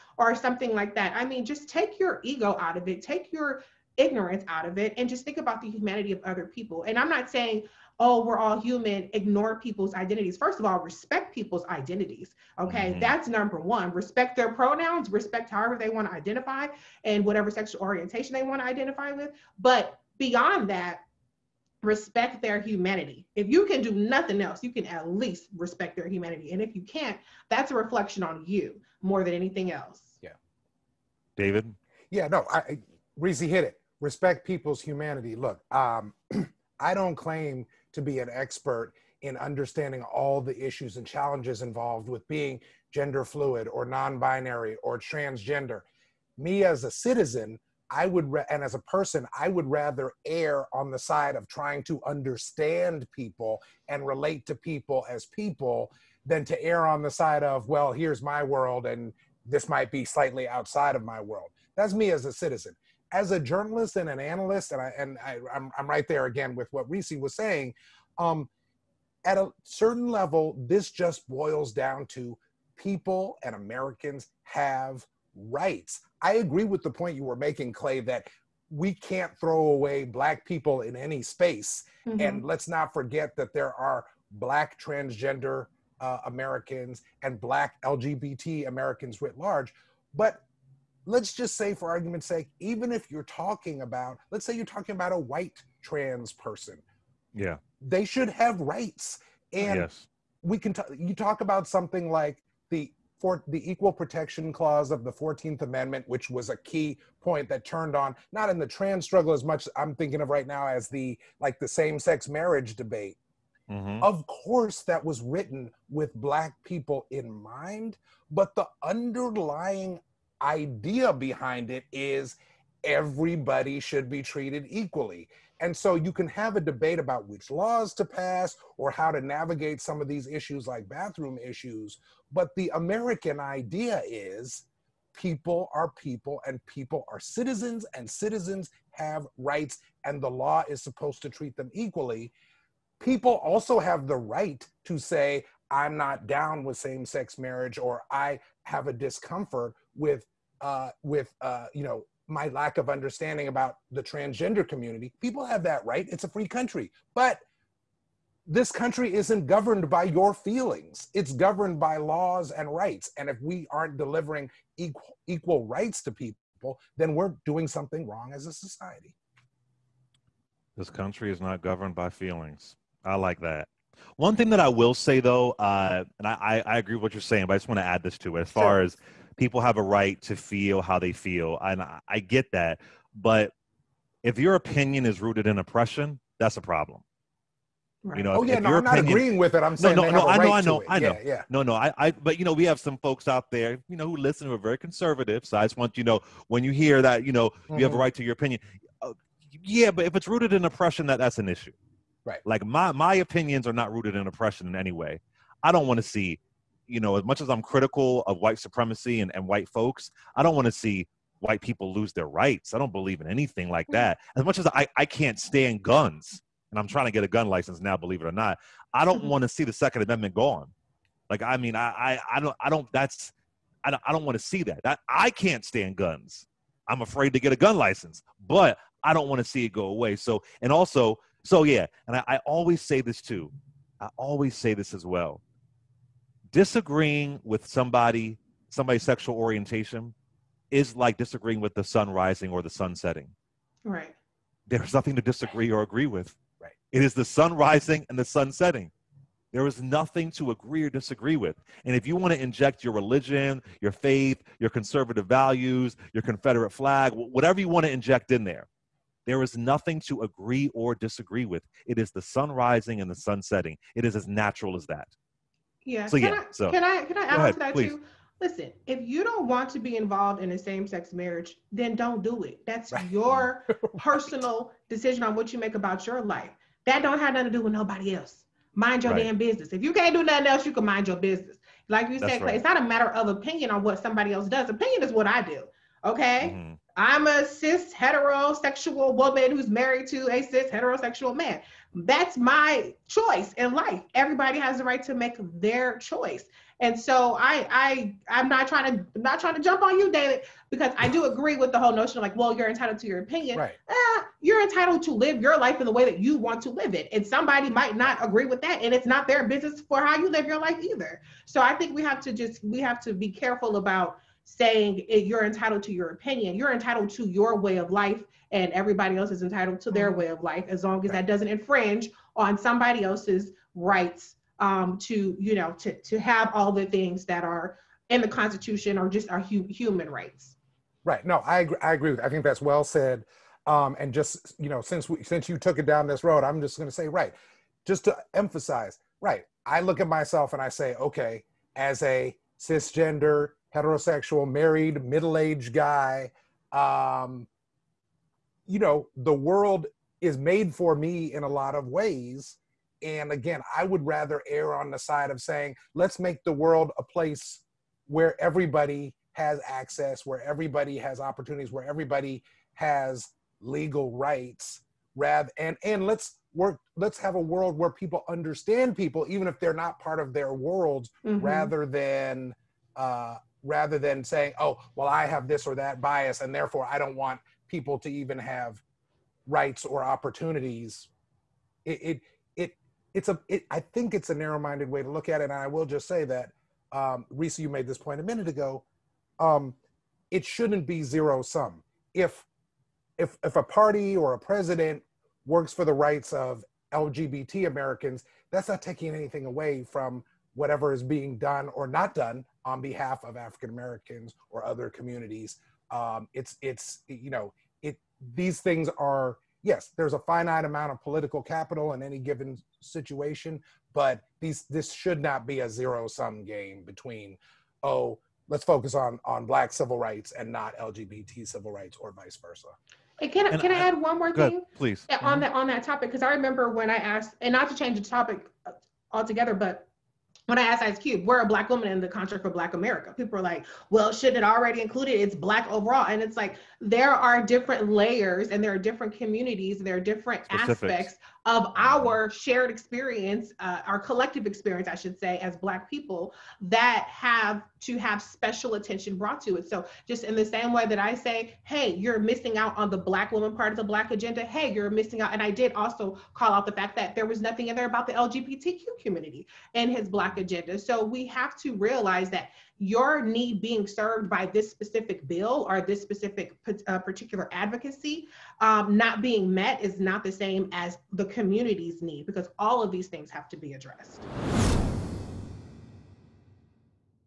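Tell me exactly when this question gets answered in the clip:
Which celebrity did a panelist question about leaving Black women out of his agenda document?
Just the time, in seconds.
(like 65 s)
430 s.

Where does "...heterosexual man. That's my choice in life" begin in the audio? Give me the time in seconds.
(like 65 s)
290 s.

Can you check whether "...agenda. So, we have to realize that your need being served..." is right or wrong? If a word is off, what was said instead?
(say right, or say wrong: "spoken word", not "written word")
right.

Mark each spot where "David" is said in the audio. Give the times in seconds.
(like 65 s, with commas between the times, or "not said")
31 s, 300 s.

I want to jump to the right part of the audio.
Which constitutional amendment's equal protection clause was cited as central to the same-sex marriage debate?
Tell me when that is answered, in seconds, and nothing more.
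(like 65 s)
105 s.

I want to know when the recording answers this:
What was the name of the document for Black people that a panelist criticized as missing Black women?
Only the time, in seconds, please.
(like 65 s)
432 s.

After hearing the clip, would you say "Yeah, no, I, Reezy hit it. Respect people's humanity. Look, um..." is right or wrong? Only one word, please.
right.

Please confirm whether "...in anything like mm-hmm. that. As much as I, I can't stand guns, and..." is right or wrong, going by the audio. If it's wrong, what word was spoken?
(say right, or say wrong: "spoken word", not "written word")
right.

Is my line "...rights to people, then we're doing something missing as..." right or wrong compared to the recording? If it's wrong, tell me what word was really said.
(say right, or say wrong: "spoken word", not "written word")
wrong: "wrong", not "missing".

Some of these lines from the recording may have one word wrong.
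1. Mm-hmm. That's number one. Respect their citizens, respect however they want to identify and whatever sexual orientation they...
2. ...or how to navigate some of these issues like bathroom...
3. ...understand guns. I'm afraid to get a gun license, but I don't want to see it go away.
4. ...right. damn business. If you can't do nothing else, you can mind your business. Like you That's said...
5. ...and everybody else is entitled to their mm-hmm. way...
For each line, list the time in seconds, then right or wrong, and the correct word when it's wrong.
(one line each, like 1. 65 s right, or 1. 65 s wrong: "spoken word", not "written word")
1. 12 s wrong: "pronouns", not "citizens"
2. 128 s right
3. 225 s wrong: "stand", not "understand"
4. 279 s right
5. 318 s right.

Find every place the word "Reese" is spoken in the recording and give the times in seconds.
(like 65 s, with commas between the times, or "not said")
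66 s, 387 s.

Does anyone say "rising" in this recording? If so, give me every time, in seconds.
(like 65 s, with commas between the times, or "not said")
242 s, 247 s, 262 s.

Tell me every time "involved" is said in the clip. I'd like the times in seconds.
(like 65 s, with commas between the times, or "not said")
41 s, 269 s.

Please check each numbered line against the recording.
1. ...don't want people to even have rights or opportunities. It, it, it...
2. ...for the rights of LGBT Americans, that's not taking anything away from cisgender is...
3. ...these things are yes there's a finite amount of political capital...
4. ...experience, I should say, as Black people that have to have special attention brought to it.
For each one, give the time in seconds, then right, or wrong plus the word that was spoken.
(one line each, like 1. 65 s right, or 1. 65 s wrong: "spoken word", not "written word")
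1. 376 s right
2. 395 s wrong: "whatever", not "cisgender"
3. 408 s right
4. 444 s right.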